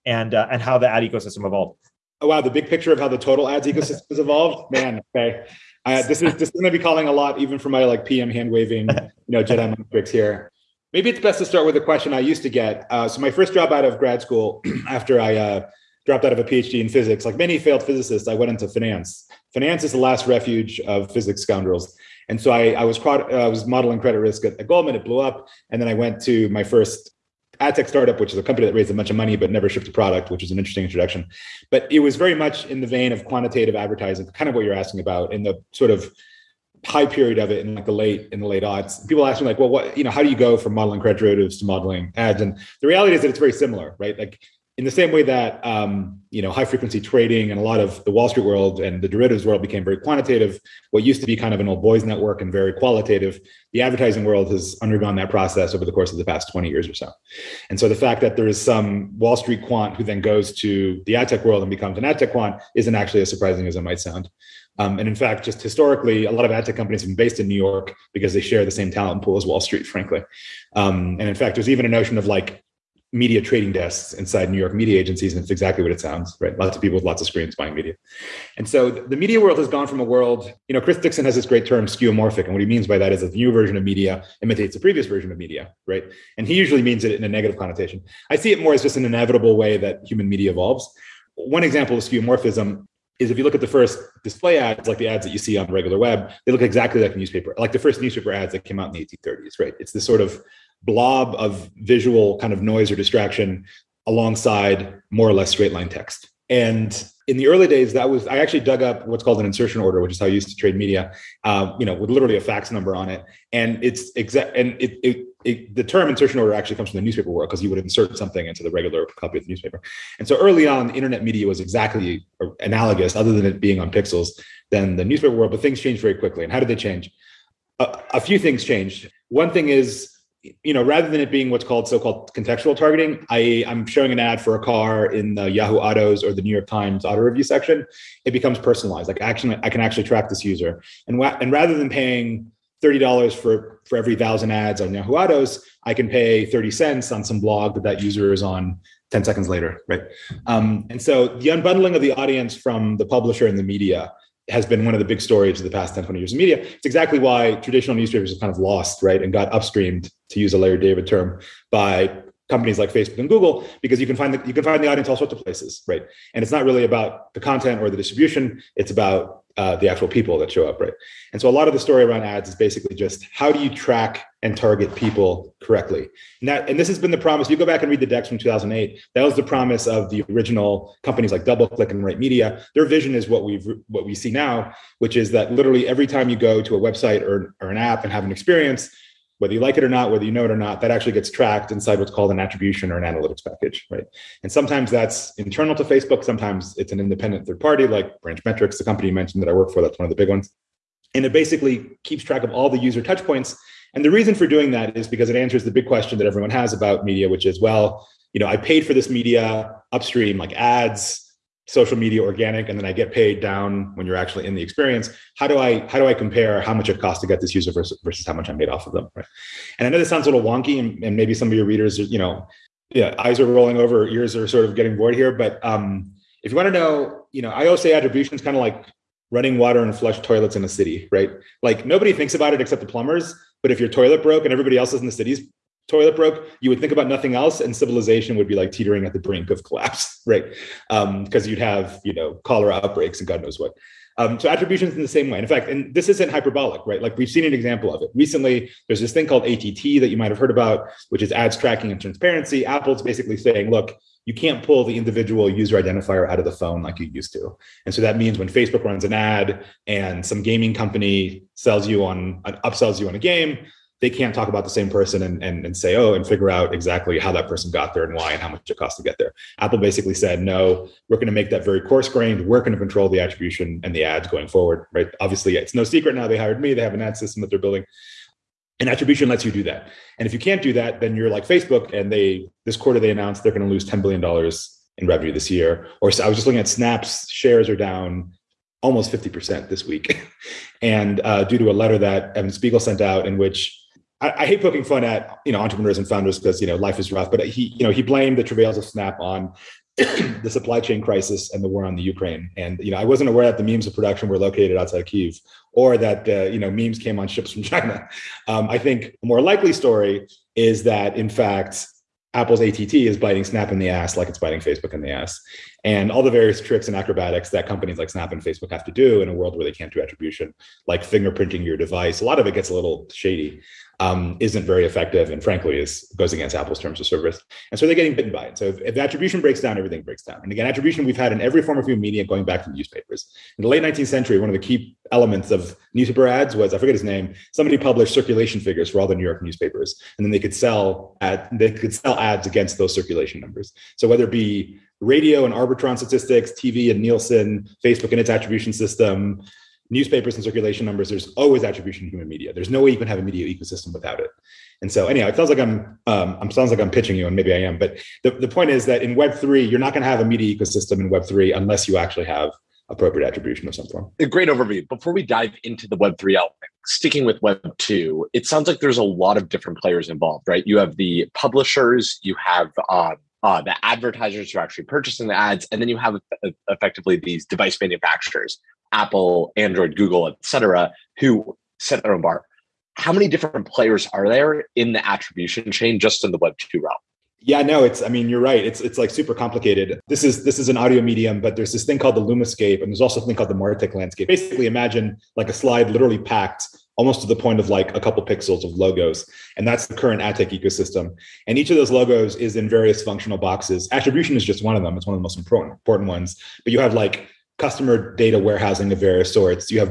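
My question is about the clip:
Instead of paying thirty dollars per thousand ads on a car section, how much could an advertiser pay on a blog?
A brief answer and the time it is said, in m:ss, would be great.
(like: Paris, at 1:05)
thirty cents, at 2:26.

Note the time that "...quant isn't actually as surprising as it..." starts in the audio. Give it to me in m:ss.
1:02.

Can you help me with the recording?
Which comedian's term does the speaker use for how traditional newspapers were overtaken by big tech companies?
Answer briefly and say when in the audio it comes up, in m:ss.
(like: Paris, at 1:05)
Larry David, at 2:40.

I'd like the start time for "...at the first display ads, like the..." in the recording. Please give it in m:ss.
1:33.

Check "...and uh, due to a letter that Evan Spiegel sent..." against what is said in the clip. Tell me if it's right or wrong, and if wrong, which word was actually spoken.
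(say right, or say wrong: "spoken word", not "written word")
right.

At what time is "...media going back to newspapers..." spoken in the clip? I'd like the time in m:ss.
5:32.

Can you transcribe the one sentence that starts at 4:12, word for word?
Apple's basically saying, look, you can't pull the individual user identifier out of the phone like you used to.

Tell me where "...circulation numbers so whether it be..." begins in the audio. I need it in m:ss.
5:42.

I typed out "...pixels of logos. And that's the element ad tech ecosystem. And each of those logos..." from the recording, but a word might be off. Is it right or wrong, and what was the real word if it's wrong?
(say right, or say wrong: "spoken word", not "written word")
wrong: "current", not "element".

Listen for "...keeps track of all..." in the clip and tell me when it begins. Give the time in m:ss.
3:22.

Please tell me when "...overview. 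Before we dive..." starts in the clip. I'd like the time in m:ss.
6:04.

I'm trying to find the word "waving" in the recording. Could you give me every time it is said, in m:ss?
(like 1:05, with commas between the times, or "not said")
0:08.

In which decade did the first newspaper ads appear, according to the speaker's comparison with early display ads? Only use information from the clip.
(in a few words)
1830s.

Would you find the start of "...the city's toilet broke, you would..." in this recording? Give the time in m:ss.
3:55.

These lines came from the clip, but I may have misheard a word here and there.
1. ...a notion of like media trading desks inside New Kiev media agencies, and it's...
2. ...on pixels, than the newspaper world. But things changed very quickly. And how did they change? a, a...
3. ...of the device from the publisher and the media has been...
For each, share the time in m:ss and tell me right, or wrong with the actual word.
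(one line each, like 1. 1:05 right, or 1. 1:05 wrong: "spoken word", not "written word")
1. 1:11 wrong: "York", not "Kiev"
2. 2:03 right
3. 2:31 wrong: "audience", not "device".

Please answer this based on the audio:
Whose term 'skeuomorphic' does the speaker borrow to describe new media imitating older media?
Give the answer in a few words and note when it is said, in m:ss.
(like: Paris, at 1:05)
Chris Dixon, at 1:20.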